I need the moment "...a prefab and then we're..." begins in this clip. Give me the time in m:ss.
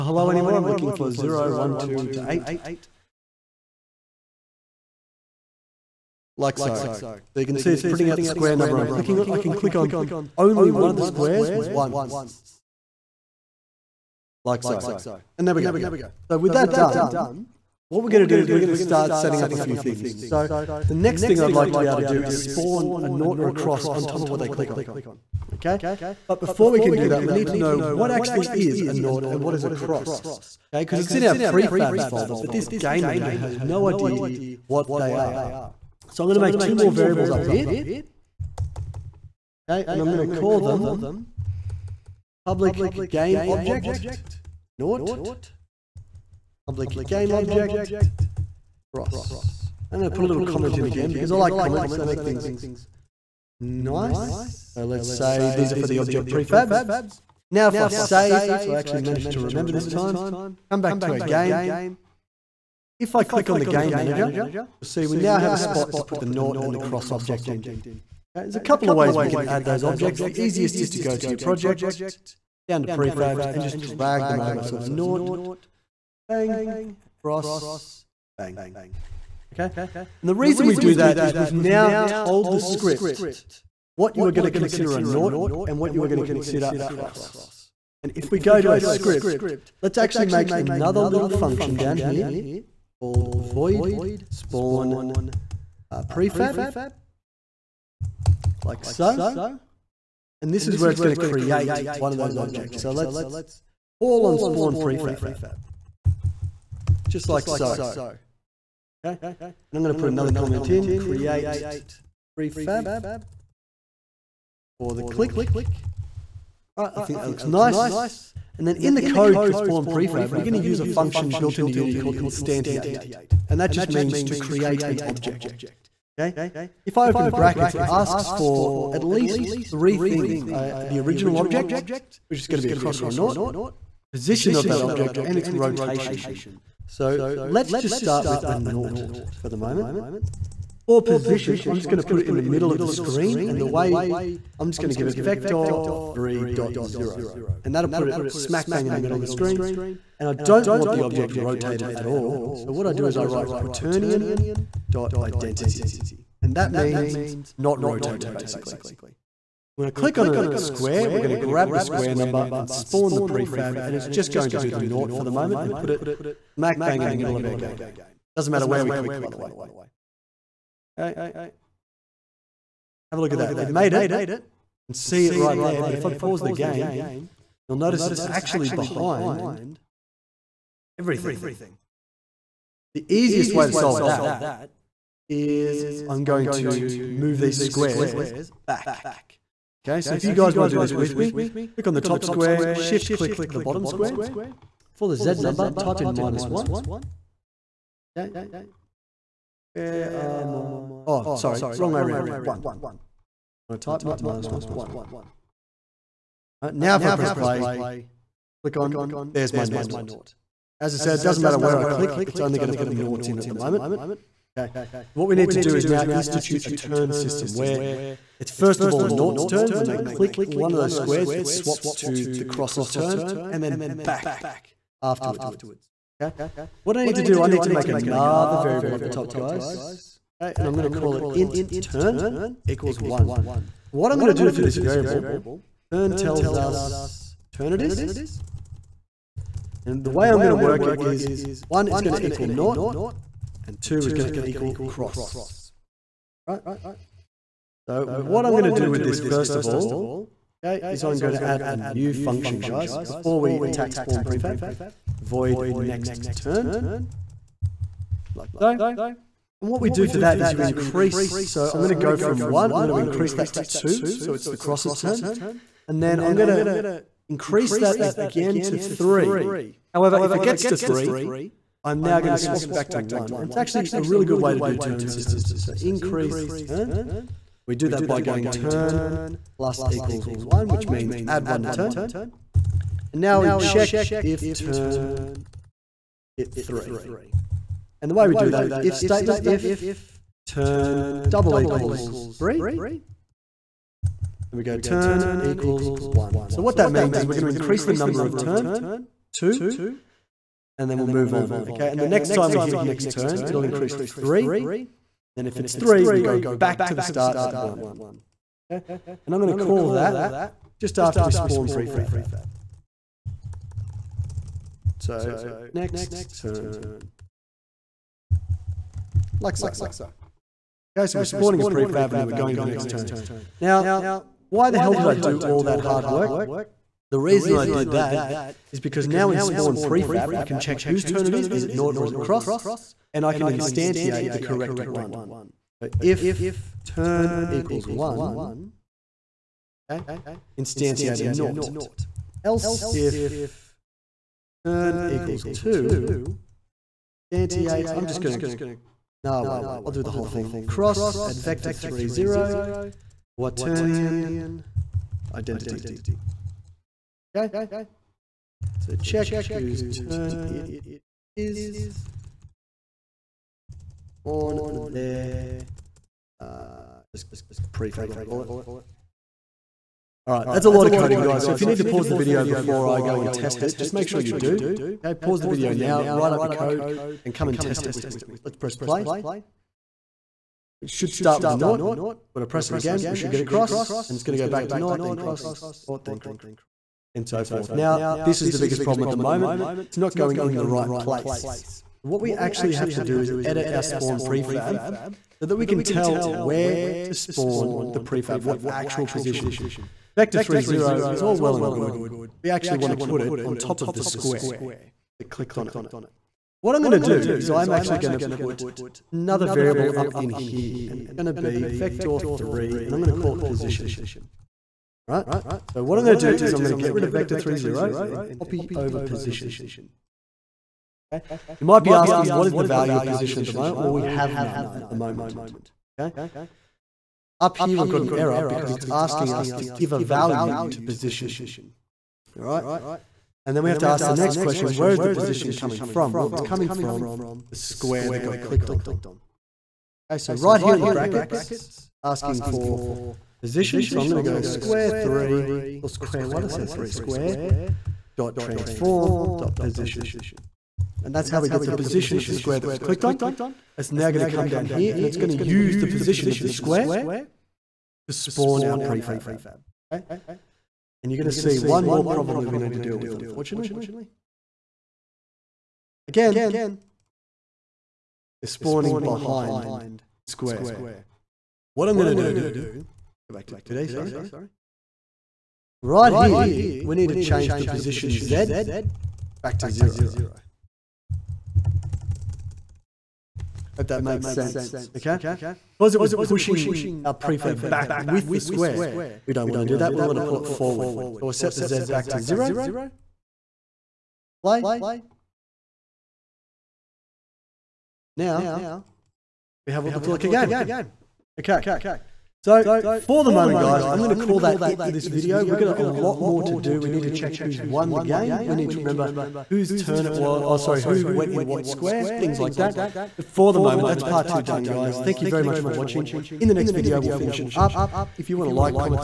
5:21.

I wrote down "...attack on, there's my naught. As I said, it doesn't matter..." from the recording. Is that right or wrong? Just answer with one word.
wrong.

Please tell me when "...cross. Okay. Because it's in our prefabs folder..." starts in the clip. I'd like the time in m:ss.
0:29.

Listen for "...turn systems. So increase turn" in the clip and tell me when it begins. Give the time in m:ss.
4:34.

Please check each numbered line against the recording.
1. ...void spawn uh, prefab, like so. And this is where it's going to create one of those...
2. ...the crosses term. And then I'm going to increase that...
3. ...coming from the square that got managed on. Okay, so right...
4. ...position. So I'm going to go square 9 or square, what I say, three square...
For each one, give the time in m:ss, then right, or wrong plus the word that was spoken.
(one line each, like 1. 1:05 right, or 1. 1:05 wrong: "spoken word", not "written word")
1. 1:33 right
2. 4:24 right
3. 7:16 wrong: "clicked", not "managed"
4. 7:23 wrong: "3", not "9".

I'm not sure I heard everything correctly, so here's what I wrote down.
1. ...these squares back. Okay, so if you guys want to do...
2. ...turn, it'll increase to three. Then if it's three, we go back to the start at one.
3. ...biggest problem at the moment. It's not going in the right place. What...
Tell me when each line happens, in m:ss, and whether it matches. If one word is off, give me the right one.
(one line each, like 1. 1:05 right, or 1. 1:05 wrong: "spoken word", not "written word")
1. 3:07 right
2. 5:03 right
3. 6:28 right.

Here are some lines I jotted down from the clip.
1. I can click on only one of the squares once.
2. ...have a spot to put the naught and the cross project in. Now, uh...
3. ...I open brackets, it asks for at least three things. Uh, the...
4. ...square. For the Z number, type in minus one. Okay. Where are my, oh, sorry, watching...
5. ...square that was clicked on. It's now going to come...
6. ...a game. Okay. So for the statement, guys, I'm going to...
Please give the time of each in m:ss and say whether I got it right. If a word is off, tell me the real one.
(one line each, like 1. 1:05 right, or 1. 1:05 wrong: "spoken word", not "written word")
1. 0:09 right
2. 1:05 wrong: "object", not "project"
3. 2:06 right
4. 3:13 wrong: "wrong", not "watching"
5. 7:32 right
6. 8:20 wrong: "moment", not "statement".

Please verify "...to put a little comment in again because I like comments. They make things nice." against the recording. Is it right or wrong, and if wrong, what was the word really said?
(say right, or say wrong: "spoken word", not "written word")
right.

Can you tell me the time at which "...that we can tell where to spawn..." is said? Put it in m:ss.
6:35.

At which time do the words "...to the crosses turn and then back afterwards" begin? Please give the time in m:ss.
3:41.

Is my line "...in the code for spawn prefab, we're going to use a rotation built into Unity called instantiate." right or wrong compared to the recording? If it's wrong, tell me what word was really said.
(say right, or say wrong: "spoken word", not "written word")
wrong: "function", not "rotation".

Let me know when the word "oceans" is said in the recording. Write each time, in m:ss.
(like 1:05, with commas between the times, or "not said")
not said.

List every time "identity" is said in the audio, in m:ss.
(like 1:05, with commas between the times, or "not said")
2:35, 5:55.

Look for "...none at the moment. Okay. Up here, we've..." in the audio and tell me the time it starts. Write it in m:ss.
7:04.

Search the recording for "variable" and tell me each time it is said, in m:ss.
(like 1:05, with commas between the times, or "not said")
0:36, 3:48, 3:54, 6:49.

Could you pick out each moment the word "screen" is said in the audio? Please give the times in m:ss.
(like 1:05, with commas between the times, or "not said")
2:22, 2:29.